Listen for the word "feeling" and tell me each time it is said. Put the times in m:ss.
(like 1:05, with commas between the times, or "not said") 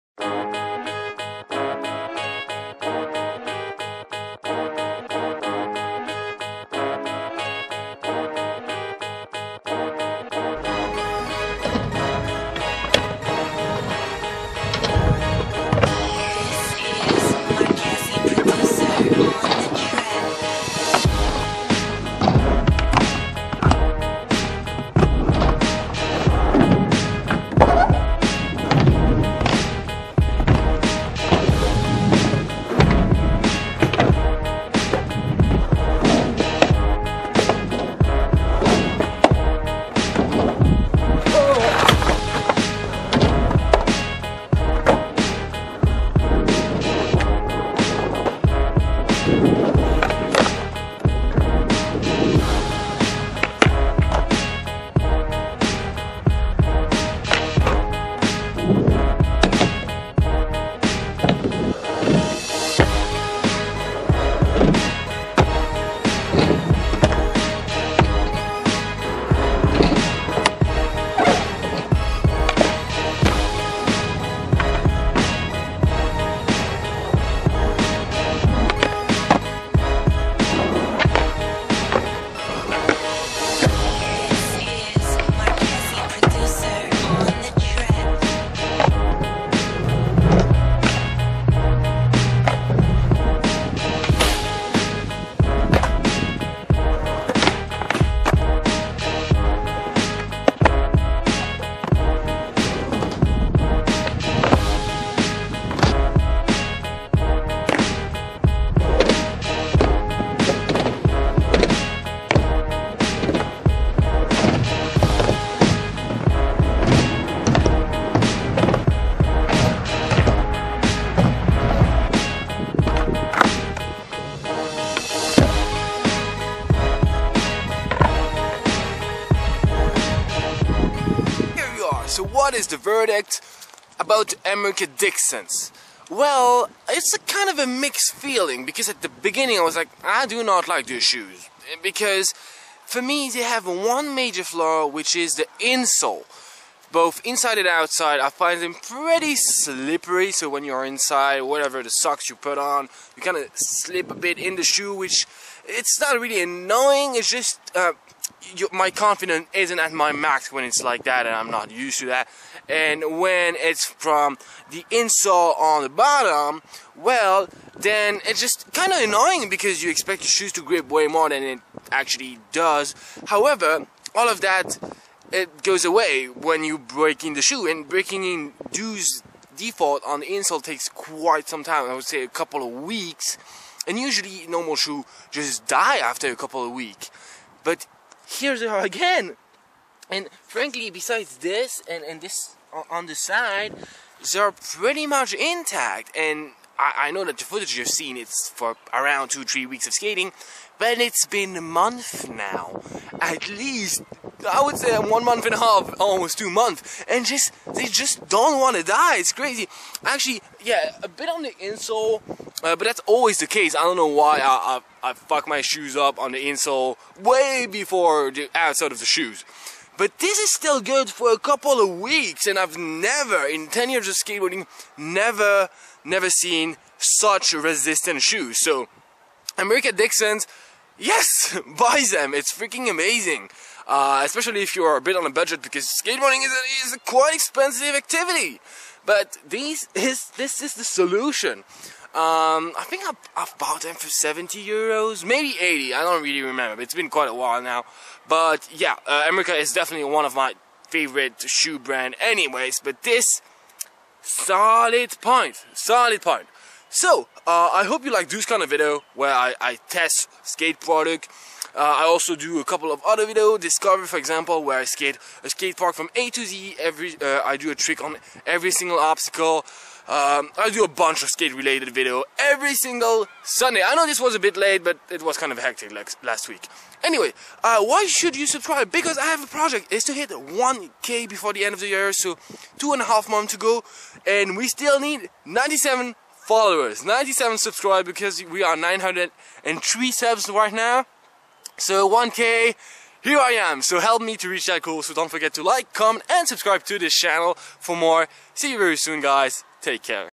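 2:18.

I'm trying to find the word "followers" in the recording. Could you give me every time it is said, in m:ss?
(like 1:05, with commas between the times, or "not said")
4:46.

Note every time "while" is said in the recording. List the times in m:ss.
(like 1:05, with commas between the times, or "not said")
4:07.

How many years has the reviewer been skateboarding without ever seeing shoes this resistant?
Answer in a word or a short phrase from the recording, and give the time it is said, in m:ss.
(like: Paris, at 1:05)
10, at 3:43.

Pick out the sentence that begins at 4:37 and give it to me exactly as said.
Anyway, uh, why should you subscribe?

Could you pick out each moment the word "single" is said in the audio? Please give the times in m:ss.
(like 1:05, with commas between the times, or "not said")
4:28, 4:32.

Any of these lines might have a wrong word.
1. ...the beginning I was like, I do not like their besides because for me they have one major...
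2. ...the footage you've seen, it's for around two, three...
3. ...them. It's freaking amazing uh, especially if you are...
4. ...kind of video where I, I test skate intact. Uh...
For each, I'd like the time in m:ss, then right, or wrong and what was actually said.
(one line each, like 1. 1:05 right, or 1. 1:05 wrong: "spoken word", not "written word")
1. 2:19 wrong: "shoes", not "besides"
2. 3:17 right
3. 3:52 right
4. 4:18 wrong: "product", not "intact".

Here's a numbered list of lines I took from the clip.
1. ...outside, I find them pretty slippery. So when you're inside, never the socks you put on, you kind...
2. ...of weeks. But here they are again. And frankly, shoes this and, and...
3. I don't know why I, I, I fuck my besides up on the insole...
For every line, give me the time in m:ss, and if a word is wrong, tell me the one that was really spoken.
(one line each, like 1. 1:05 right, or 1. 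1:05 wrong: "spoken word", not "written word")
1. 2:27 wrong: "whatever", not "never"
2. 3:06 wrong: "besides", not "shoes"
3. 3:33 wrong: "shoes", not "besides".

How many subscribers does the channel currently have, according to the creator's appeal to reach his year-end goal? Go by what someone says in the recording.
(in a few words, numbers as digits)
903.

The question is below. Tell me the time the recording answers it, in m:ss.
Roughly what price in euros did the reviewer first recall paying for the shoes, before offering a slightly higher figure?
4:04.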